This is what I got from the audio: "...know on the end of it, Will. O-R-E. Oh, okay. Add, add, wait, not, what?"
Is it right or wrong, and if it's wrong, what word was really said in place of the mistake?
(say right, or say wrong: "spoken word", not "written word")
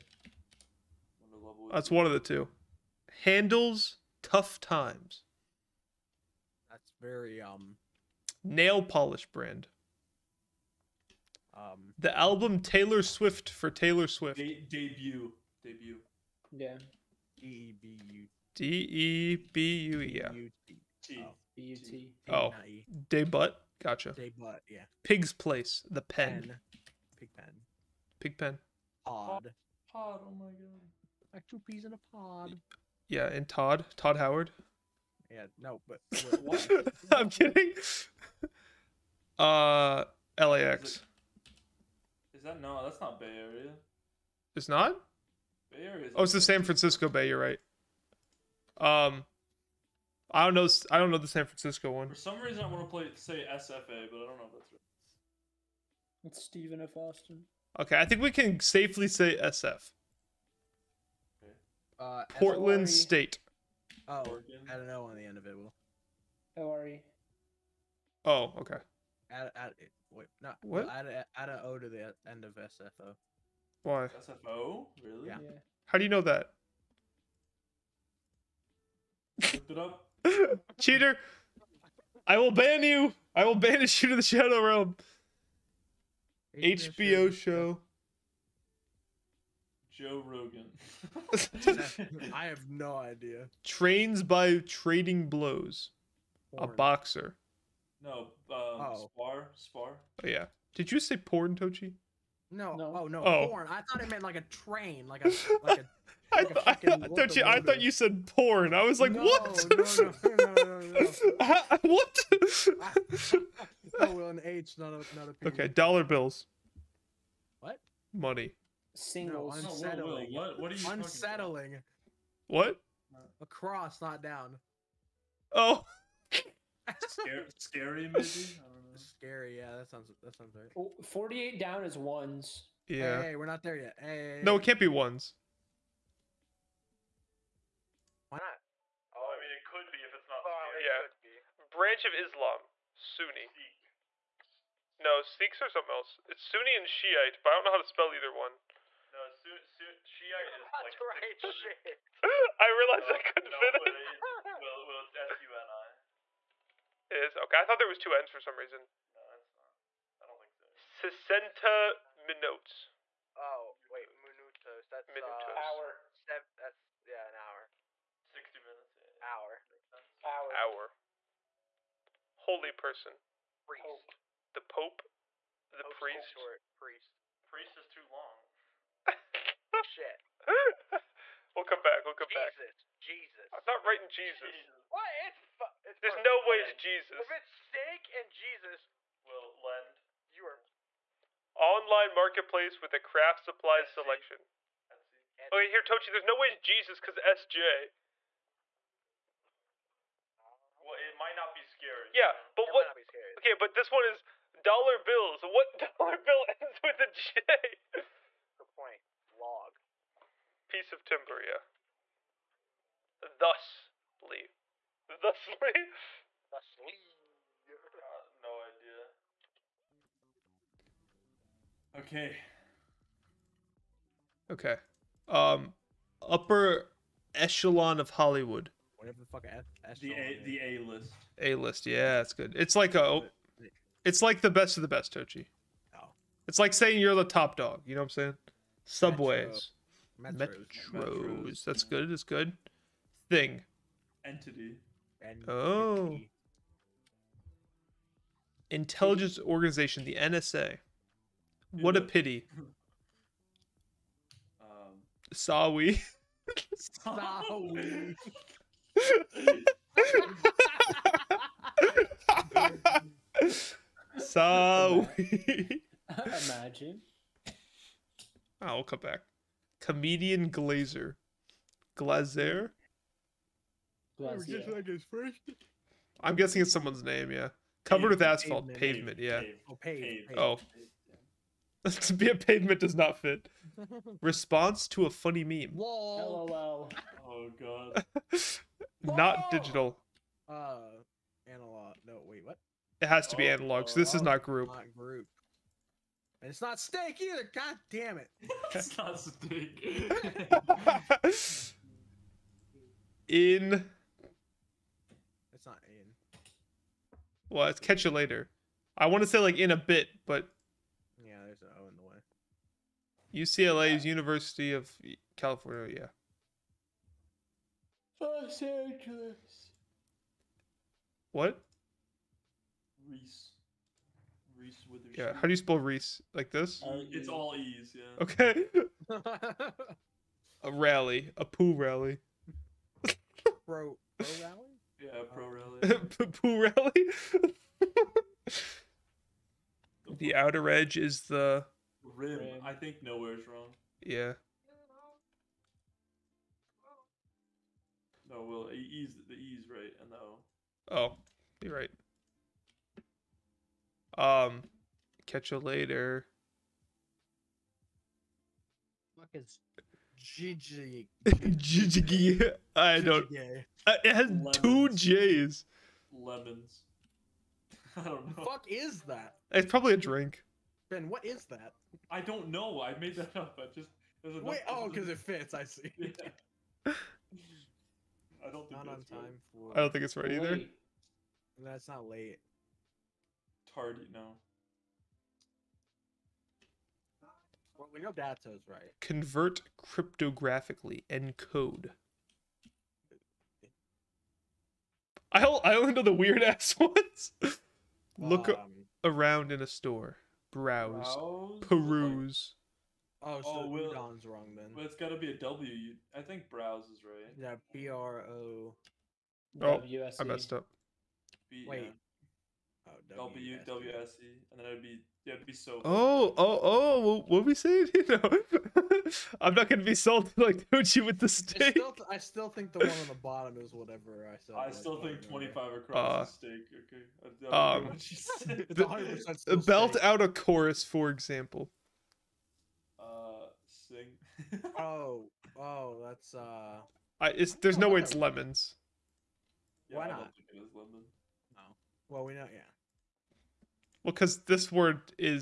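right.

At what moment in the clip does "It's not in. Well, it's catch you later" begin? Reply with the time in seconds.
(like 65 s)
305 s.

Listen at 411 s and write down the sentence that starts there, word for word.
B- Wait, Oh, and then it'd be yeah, it'd be so.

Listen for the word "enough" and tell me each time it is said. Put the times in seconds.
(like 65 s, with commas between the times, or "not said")
374 s.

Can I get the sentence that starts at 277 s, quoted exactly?
Covered with asphalt, pavement, pavement yeah.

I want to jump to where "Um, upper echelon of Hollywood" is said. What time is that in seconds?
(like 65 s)
225 s.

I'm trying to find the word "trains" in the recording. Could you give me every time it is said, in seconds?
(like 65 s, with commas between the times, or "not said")
93 s, 104 s.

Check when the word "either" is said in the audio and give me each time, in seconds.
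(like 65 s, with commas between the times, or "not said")
148 s, 297 s, 380 s.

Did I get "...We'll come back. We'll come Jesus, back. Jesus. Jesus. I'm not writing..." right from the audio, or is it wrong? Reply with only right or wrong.
right.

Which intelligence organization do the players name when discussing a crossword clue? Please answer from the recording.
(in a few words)
NSA.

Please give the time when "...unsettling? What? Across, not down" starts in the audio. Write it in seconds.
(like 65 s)
120 s.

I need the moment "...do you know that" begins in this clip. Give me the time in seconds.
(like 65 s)
75 s.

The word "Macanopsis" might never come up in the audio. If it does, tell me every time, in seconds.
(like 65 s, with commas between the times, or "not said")
not said.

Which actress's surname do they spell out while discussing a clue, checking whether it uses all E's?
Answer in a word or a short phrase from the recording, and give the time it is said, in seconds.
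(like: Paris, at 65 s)
Witherspoon, at 324 s.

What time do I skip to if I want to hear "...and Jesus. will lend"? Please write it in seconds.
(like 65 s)
188 s.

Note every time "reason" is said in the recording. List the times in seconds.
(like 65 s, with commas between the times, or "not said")
52 s, 158 s.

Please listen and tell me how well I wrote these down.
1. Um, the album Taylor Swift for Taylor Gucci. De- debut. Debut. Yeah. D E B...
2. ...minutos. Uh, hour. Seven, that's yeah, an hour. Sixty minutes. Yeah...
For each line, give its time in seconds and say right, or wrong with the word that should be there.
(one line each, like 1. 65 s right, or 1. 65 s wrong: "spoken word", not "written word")
1. 11 s wrong: "Swift", not "Gucci"
2. 165 s right.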